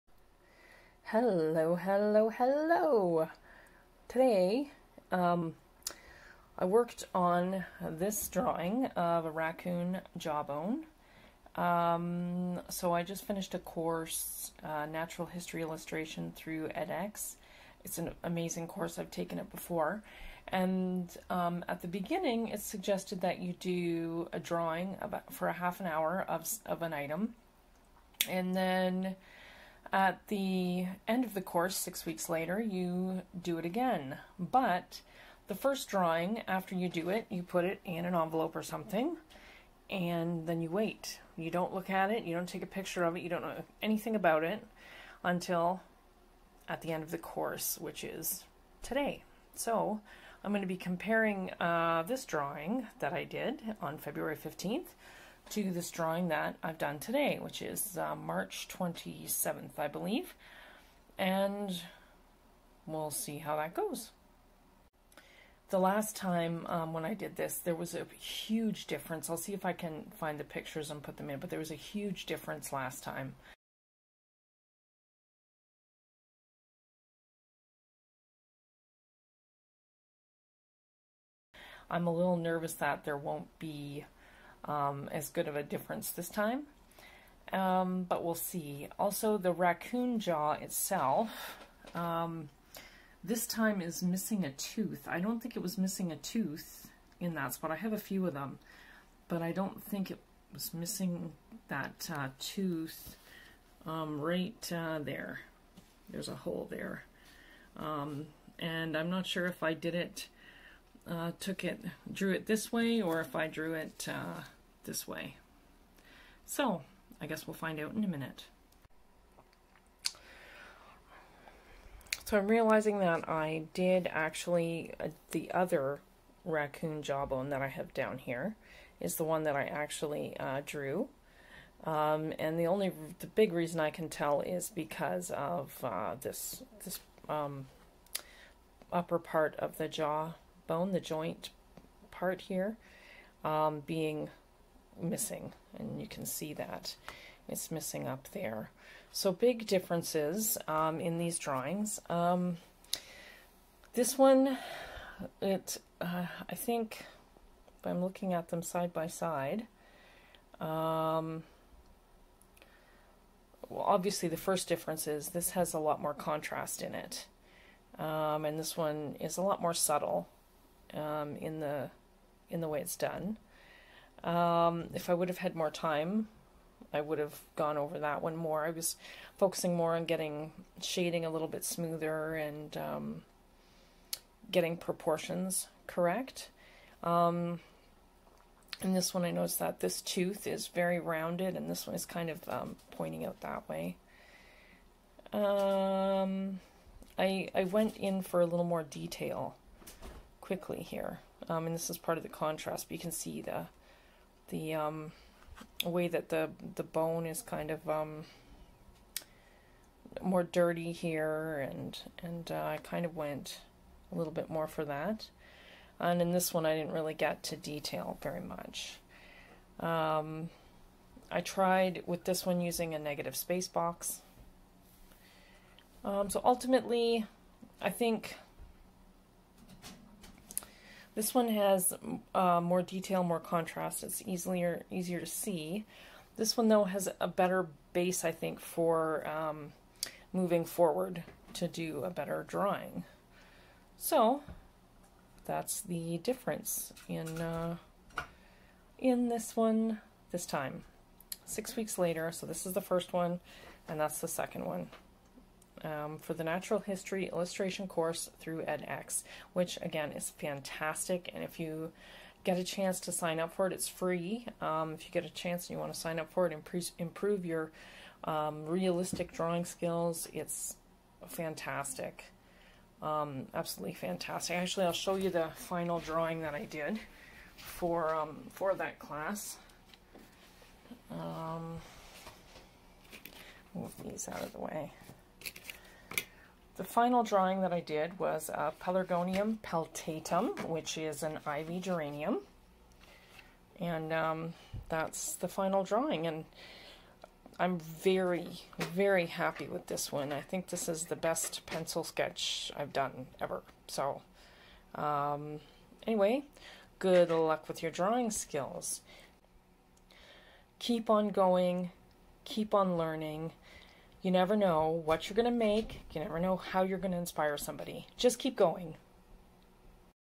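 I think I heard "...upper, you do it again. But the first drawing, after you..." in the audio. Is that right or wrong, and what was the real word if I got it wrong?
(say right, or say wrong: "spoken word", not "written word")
wrong: "later", not "upper".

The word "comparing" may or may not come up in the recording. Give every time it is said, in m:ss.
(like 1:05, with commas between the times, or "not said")
0:50.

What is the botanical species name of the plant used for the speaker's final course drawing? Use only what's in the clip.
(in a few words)
Pelargonium peltatum.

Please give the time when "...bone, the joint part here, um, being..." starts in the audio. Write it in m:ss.
2:20.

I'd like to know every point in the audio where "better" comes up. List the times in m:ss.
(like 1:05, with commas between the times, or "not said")
3:57, 4:02.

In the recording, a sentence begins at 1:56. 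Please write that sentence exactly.
So, I guess we'll find out in a minute.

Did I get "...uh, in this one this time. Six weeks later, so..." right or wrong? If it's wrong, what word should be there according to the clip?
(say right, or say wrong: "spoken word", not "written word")
right.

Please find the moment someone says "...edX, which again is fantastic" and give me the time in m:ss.
4:18.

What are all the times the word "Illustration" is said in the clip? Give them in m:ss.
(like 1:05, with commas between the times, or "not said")
0:15, 4:17.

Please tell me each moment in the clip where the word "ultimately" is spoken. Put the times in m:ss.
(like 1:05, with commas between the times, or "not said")
3:46.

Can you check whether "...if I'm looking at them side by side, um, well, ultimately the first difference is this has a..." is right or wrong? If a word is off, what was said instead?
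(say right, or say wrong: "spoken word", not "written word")
wrong: "obviously", not "ultimately".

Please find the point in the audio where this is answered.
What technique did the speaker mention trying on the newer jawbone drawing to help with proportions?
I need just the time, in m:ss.
3:42.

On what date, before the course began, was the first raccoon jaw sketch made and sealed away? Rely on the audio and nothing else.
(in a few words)
February 15th.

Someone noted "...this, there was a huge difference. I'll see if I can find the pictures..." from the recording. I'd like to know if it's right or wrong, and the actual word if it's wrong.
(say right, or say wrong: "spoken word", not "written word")
right.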